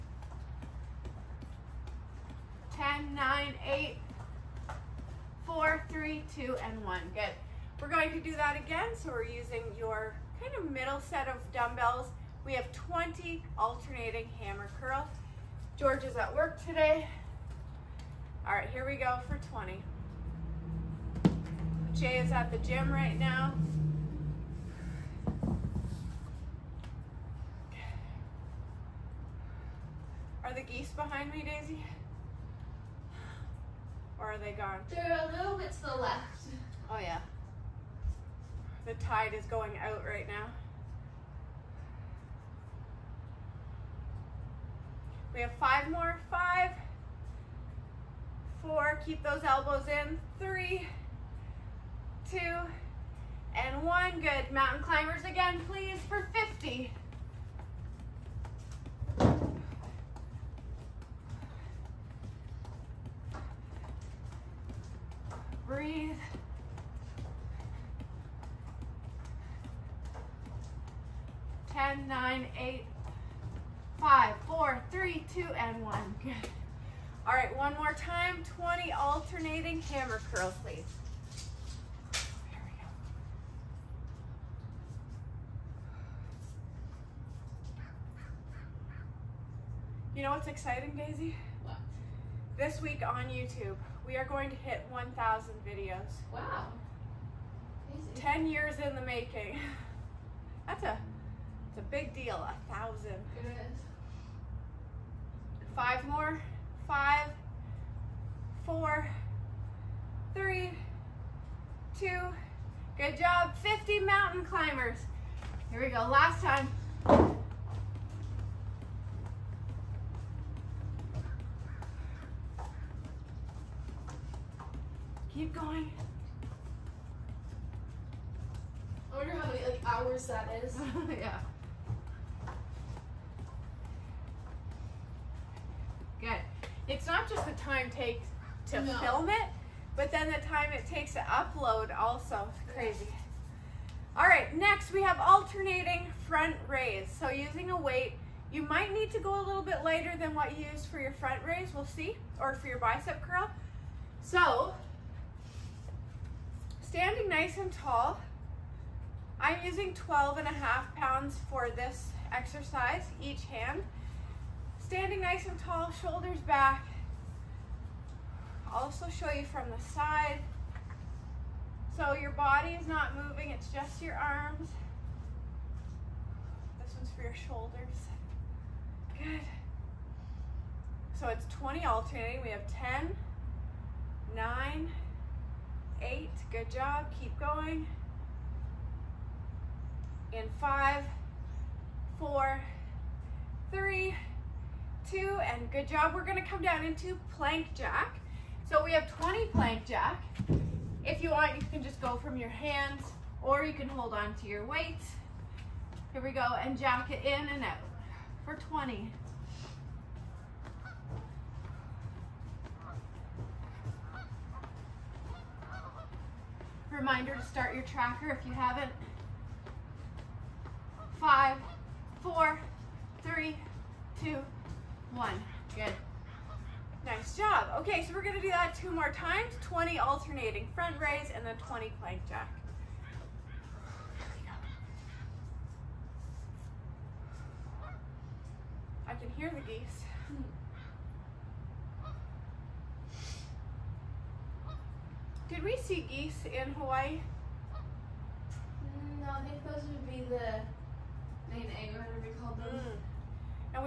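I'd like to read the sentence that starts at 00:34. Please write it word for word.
They're a little bit to the left.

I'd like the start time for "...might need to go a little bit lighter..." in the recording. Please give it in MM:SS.
02:28.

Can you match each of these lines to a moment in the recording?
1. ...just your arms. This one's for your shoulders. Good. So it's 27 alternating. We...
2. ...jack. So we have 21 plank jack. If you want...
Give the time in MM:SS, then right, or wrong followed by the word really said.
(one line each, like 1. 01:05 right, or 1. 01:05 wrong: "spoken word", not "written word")
1. 02:53 wrong: "20", not "27"
2. 03:17 wrong: "20", not "21".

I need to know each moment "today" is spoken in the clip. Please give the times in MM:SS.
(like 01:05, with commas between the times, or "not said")
00:16.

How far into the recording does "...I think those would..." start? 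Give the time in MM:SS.
04:09.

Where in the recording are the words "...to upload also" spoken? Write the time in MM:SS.
02:21.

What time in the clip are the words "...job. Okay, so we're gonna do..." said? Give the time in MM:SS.
03:47.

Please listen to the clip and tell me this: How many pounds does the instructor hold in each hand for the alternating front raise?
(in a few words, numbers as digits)
12.5.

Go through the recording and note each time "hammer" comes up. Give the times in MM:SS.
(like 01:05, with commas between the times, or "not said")
00:14, 01:19.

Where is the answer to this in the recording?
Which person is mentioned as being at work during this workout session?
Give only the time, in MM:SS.
00:15.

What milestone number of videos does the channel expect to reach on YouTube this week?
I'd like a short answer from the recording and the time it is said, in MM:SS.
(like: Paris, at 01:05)
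1,000, at 01:34.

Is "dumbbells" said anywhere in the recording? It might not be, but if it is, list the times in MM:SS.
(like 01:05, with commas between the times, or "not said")
00:11.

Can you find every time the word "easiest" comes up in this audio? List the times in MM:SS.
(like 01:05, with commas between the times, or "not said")
not said.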